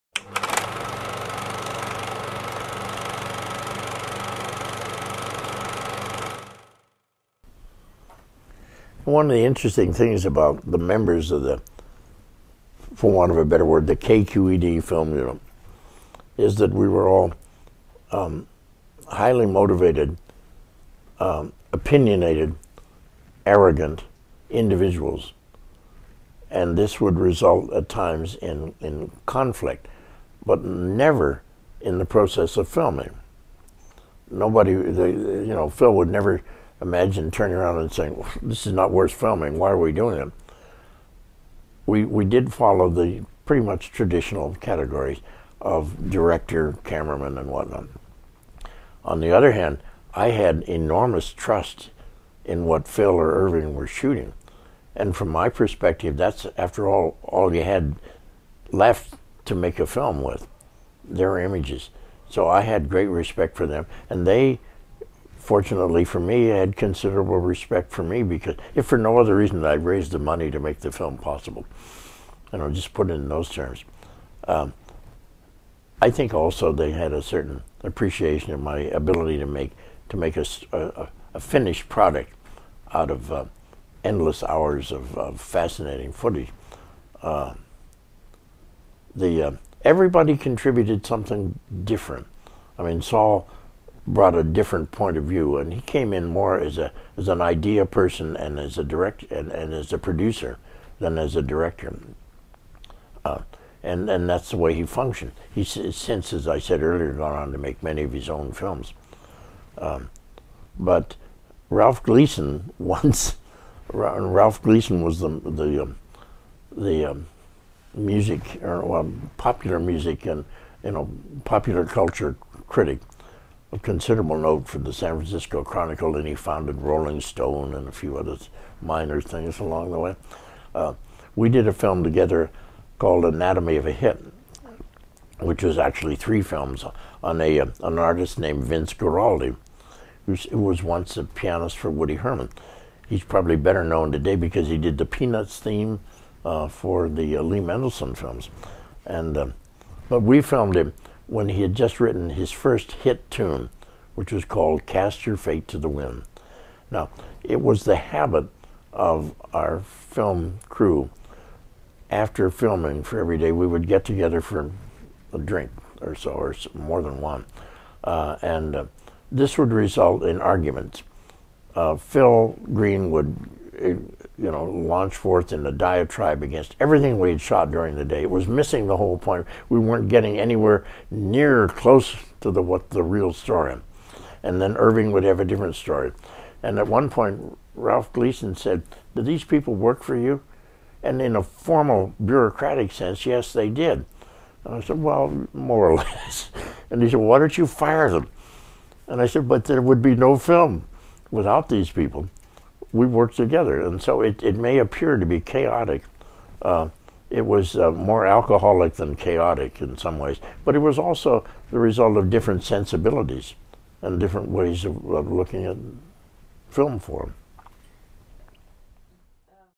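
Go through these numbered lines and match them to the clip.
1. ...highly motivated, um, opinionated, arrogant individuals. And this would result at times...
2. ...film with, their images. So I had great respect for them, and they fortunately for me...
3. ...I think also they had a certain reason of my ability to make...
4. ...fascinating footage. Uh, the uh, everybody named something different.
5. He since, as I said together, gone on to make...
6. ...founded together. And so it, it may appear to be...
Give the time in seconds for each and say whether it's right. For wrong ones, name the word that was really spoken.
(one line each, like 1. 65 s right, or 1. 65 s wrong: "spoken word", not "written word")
1. 19 s right
2. 59 s right
3. 76 s wrong: "appreciation", not "reason"
4. 85 s wrong: "contributed", not "named"
5. 105 s wrong: "earlier", not "together"
6. 203 s wrong: "worked", not "founded".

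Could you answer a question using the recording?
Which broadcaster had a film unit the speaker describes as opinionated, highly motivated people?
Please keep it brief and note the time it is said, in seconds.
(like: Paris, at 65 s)
KQED, at 13 s.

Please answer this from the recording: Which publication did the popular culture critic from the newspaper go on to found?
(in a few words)
Rolling Stone.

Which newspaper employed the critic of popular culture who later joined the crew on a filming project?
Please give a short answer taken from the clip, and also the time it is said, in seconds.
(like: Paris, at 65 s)
San Francisco Chronicle, at 124 s.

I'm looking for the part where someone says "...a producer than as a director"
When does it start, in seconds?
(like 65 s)
99 s.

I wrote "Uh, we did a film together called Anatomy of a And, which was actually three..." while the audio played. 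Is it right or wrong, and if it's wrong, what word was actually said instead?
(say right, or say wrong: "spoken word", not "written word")
wrong: "Hit", not "And".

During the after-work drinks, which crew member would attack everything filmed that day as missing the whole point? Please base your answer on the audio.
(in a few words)
Phil Greene.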